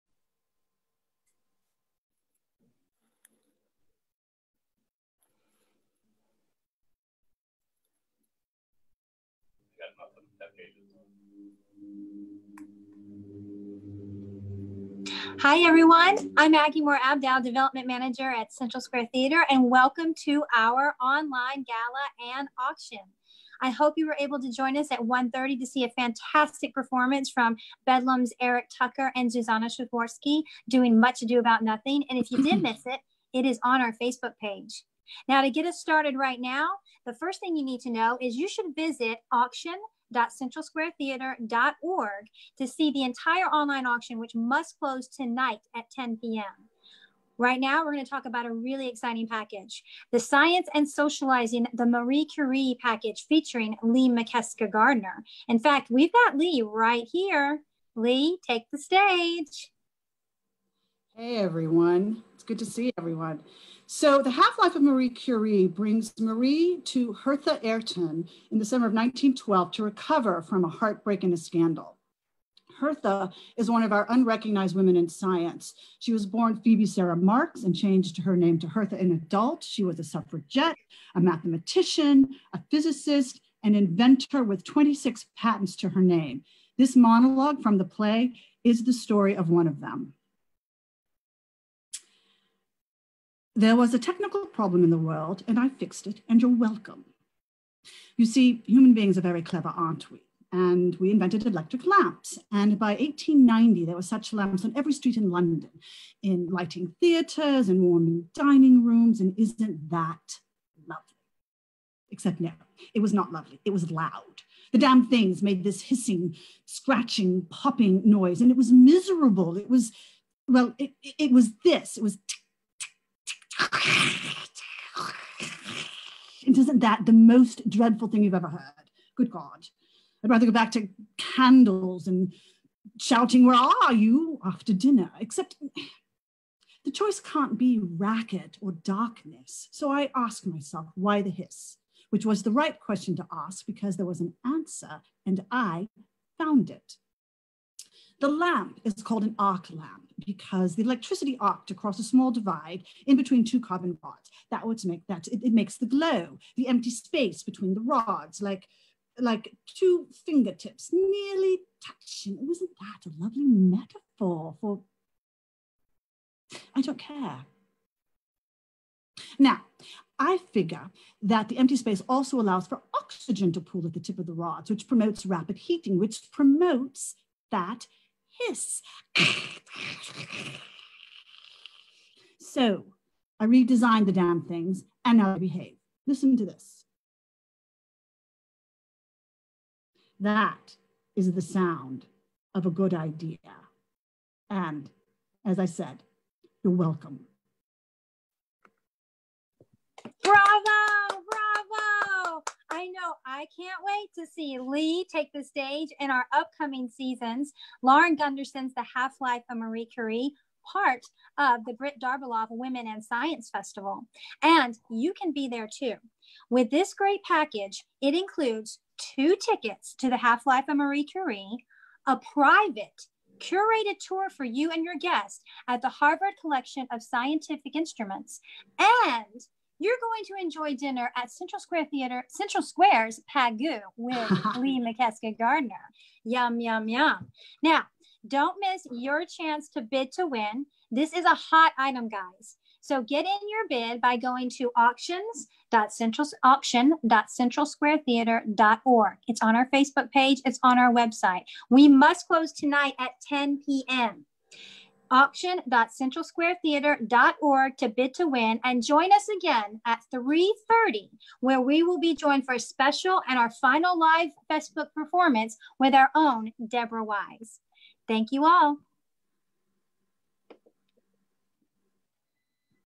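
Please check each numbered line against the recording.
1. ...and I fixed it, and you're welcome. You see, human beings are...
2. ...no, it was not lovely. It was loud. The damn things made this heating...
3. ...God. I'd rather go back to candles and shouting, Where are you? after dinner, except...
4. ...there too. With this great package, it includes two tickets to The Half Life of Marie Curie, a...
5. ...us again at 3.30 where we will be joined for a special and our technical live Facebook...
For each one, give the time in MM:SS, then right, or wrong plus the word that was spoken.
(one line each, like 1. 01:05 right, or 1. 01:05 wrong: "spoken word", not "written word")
1. 01:35 right
2. 01:52 wrong: "hissing", not "heating"
3. 02:09 right
4. 03:35 right
5. 04:19 wrong: "final", not "technical".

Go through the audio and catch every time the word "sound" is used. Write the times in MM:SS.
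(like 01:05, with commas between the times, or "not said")
03:11.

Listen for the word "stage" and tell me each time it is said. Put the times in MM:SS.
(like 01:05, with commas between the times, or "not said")
00:58, 03:25.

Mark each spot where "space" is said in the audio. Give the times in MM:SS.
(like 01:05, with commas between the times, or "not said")
02:36, 02:51.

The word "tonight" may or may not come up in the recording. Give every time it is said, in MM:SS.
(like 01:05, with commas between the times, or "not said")
00:45, 04:12.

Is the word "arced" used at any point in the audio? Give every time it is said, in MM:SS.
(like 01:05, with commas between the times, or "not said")
02:31.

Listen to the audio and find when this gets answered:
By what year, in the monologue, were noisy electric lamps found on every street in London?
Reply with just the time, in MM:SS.
01:42.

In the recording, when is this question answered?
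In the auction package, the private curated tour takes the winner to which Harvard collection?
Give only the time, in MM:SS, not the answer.
03:45.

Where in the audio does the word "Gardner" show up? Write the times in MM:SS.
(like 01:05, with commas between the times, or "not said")
00:54, 03:55.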